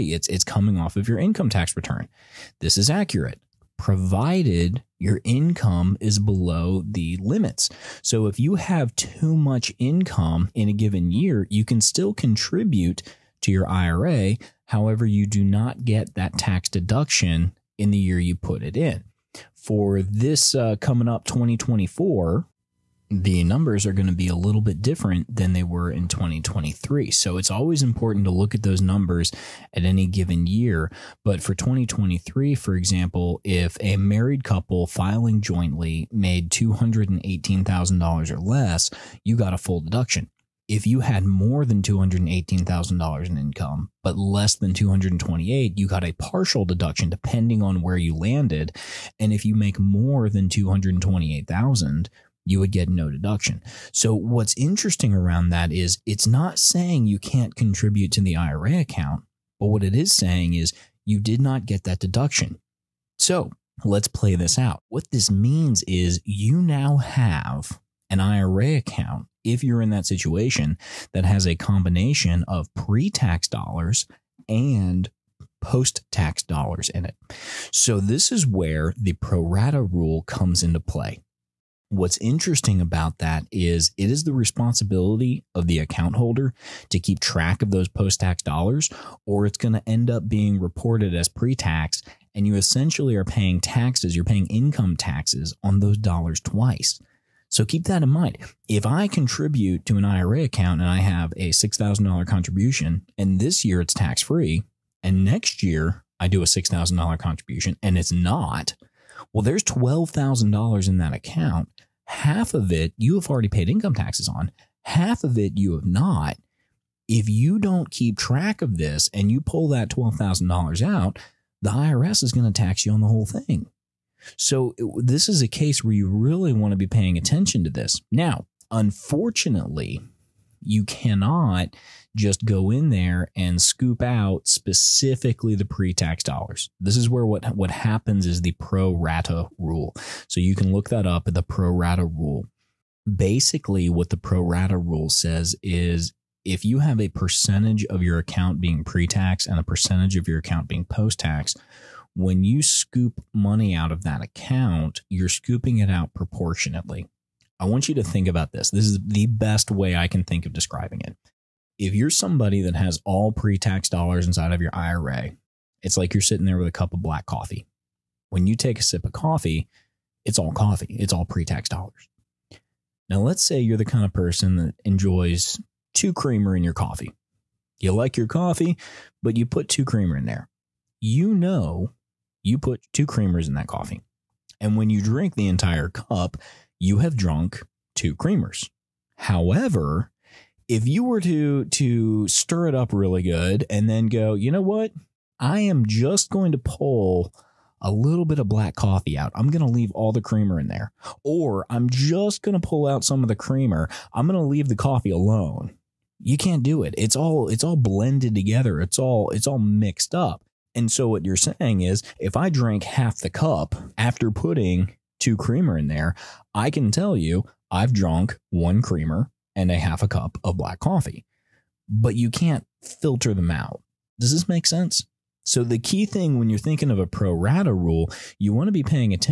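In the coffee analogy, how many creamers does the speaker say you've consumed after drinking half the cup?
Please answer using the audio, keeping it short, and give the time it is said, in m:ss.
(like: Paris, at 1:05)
1, at 3:38.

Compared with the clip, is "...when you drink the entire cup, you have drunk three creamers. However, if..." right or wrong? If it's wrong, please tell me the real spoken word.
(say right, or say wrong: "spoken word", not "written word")
wrong: "two", not "three".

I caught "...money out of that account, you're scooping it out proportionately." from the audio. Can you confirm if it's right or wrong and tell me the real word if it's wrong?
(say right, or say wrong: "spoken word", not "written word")
right.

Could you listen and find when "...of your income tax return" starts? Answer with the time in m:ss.
0:00.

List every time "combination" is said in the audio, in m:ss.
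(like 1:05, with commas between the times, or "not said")
1:11.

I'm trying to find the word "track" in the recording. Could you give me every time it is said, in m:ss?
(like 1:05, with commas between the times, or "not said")
1:27, 1:58.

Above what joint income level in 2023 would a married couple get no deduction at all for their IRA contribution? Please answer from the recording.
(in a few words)
228,000.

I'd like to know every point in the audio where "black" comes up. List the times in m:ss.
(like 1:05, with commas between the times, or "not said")
2:47, 3:18, 3:40.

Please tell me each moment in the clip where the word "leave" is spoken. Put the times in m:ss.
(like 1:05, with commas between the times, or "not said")
3:19, 3:24.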